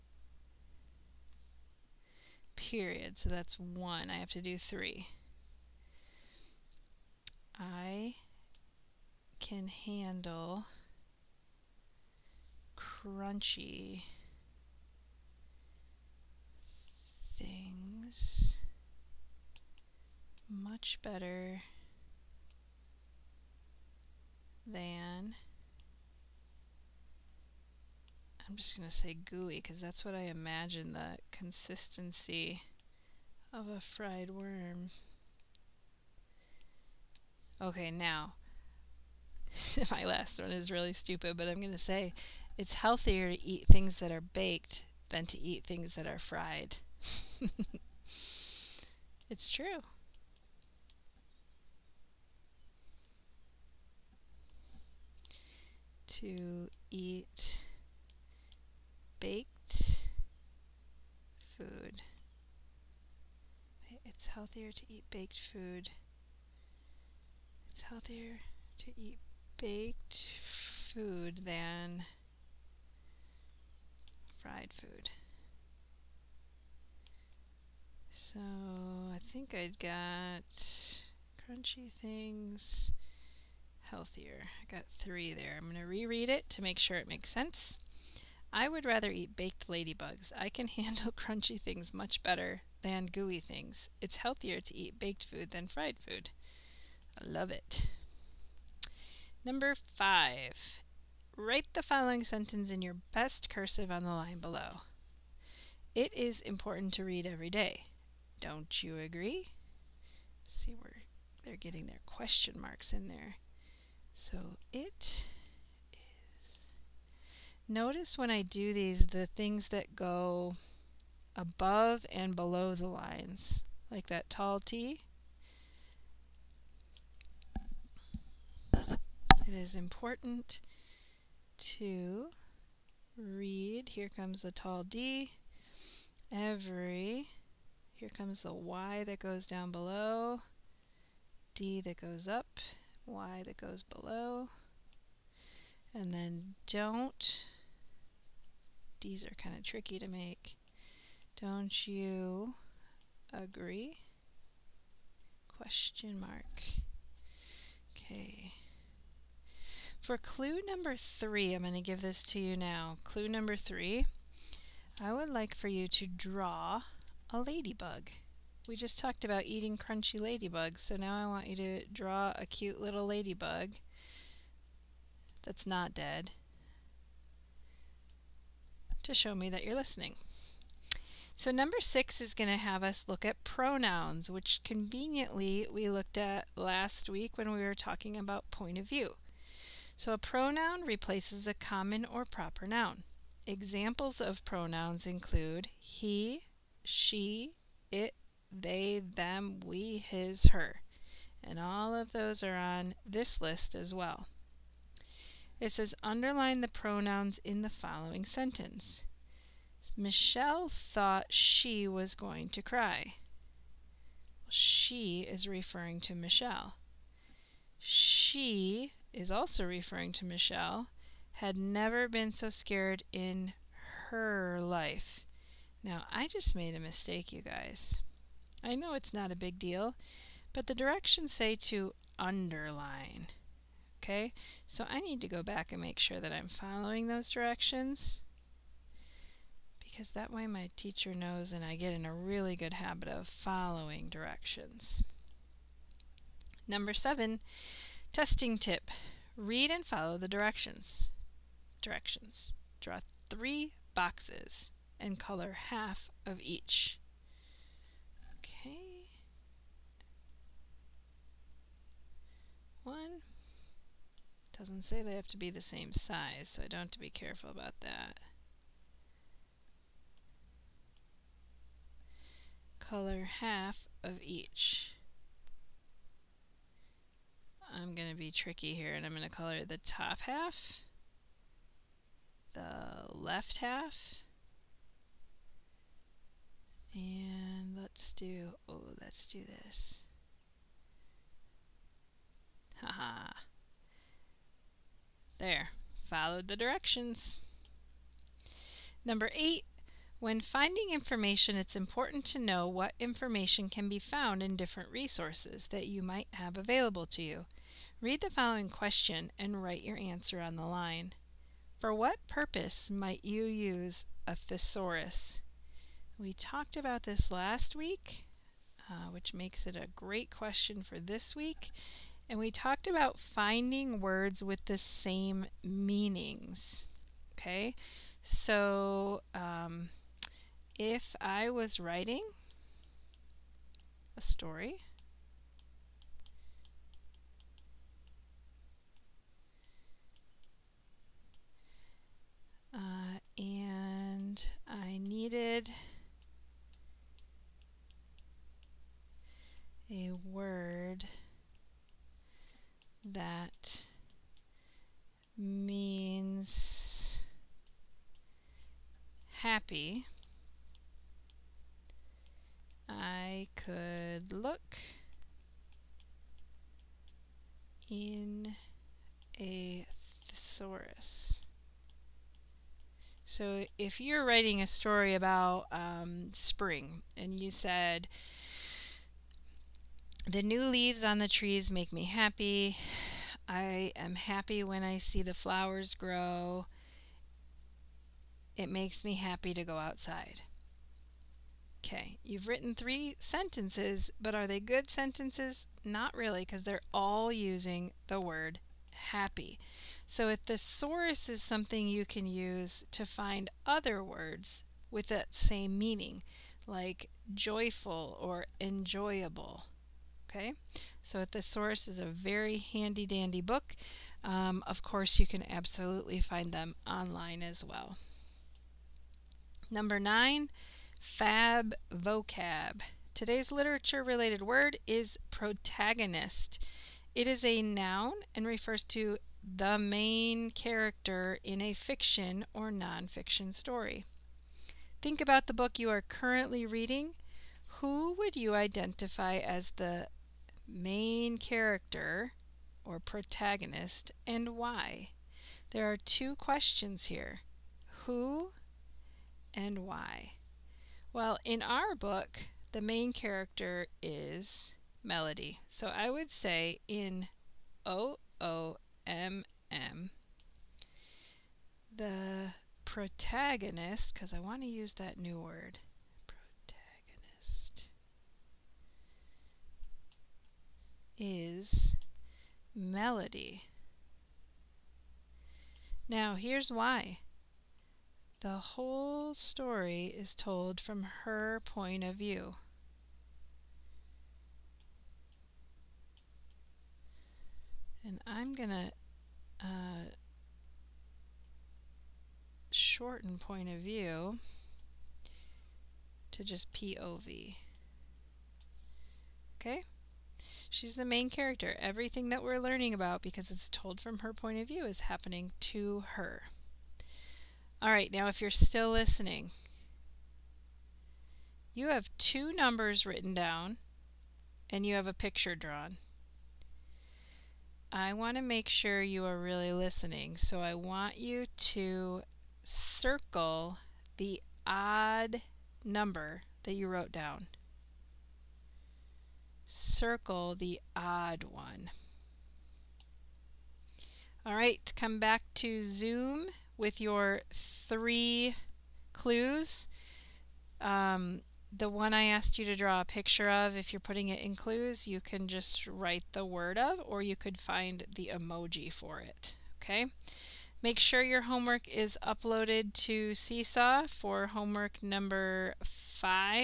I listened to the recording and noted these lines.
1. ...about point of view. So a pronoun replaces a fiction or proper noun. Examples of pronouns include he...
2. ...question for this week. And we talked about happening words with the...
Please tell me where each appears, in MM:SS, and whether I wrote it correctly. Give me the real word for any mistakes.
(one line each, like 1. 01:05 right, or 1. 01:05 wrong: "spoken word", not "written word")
1. 03:08 wrong: "common", not "fiction"
2. 05:20 wrong: "finding", not "happening".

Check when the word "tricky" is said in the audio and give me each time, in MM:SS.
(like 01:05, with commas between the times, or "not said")
02:29, 04:38.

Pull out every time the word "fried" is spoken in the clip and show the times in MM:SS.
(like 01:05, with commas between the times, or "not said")
00:33, 00:46, 01:14, 01:35.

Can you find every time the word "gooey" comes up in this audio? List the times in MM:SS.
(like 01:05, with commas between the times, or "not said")
00:29, 01:33.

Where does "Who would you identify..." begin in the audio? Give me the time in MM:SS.
07:17.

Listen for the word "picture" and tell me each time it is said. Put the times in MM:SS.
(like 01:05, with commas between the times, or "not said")
08:35, 09:03.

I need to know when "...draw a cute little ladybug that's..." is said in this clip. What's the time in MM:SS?
02:51.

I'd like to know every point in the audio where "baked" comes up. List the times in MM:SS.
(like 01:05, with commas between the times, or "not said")
00:44, 00:59, 01:05, 01:09, 01:29, 01:34.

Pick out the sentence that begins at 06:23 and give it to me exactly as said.
I am happy when I see the flowers grow.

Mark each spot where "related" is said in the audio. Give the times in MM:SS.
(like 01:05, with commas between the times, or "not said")
07:04.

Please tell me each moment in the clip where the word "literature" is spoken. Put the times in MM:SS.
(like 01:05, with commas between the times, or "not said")
07:03.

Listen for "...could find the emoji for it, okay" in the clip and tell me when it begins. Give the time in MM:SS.
09:07.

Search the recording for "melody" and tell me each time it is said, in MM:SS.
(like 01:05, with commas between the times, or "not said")
07:35, 07:52.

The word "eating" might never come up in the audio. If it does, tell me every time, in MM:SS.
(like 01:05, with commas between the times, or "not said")
02:49.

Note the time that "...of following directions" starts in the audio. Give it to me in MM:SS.
04:03.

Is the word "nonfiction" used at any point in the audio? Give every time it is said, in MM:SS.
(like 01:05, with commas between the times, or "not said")
07:12.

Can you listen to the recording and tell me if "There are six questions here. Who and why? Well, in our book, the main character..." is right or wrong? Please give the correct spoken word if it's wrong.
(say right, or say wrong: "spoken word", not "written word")
wrong: "two", not "six".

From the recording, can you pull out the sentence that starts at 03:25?
It says underline the pronouns in the following sentence.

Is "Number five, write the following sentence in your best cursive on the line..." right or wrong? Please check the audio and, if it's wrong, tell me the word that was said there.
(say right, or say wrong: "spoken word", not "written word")
right.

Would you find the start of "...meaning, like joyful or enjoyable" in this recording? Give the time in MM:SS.
06:45.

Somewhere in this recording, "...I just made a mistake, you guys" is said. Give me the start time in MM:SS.
03:46.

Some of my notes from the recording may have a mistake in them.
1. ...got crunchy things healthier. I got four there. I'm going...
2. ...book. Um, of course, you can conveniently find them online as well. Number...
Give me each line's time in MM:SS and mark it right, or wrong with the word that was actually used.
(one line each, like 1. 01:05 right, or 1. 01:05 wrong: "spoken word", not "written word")
1. 01:19 wrong: "three", not "four"
2. 06:53 wrong: "absolutely", not "conveniently".